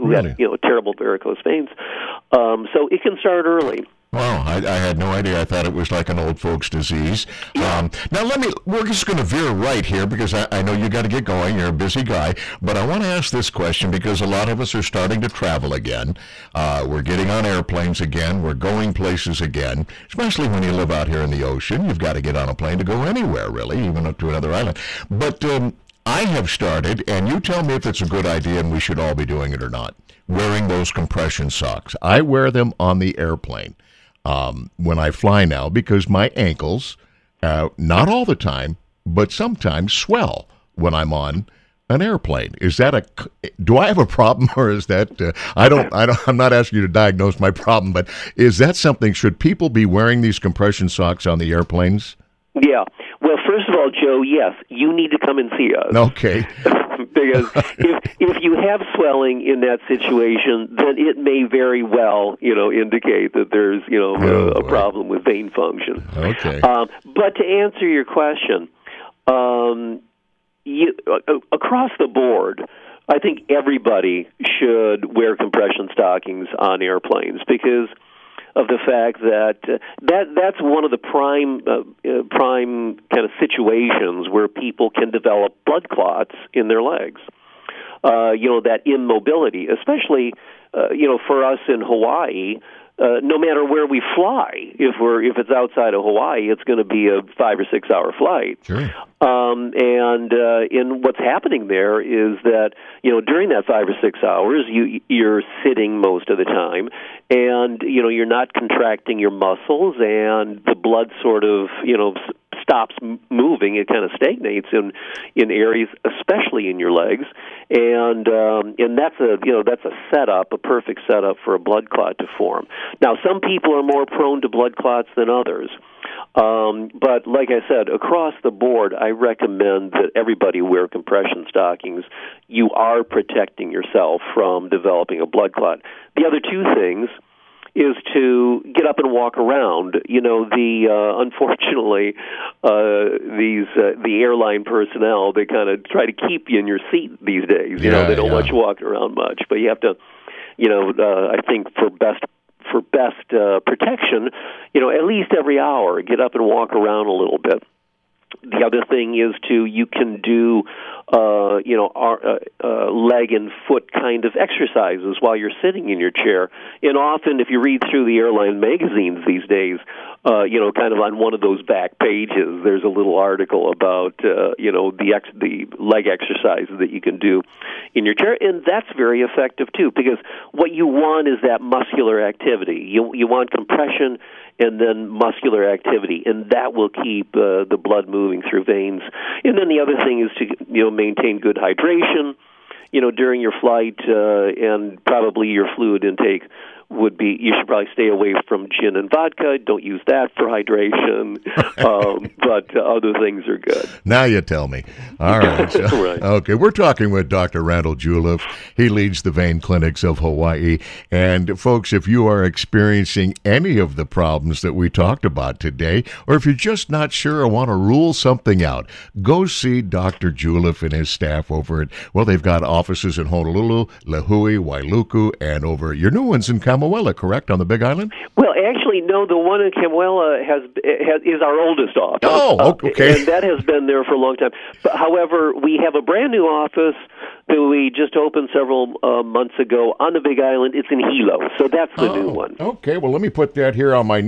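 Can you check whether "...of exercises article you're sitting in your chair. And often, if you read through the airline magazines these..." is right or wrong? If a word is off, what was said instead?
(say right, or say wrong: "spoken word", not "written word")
wrong: "while", not "article".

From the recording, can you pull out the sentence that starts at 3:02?
You you want compression and then muscular activity, and that will keep uh, the blood moving moving through veins.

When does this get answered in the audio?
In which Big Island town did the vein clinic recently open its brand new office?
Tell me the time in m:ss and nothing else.
4:00.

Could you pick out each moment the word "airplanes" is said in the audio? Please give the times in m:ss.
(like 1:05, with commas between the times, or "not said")
0:17, 0:33, 0:42, 0:51, 1:16.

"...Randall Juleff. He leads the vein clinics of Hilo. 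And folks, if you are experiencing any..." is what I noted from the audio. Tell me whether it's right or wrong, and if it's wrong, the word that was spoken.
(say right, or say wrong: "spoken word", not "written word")
wrong: "Hawaii", not "Hilo".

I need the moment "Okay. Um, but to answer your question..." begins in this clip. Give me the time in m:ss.
1:06.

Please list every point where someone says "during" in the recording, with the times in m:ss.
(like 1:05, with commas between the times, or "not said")
1:43, 3:13.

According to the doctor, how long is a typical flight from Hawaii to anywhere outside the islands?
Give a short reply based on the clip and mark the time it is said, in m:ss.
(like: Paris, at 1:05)
5 or 6 hours, at 1:37.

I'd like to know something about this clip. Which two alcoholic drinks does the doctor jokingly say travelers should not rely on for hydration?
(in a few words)
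gin and vodka.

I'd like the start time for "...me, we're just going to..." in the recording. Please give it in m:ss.
0:08.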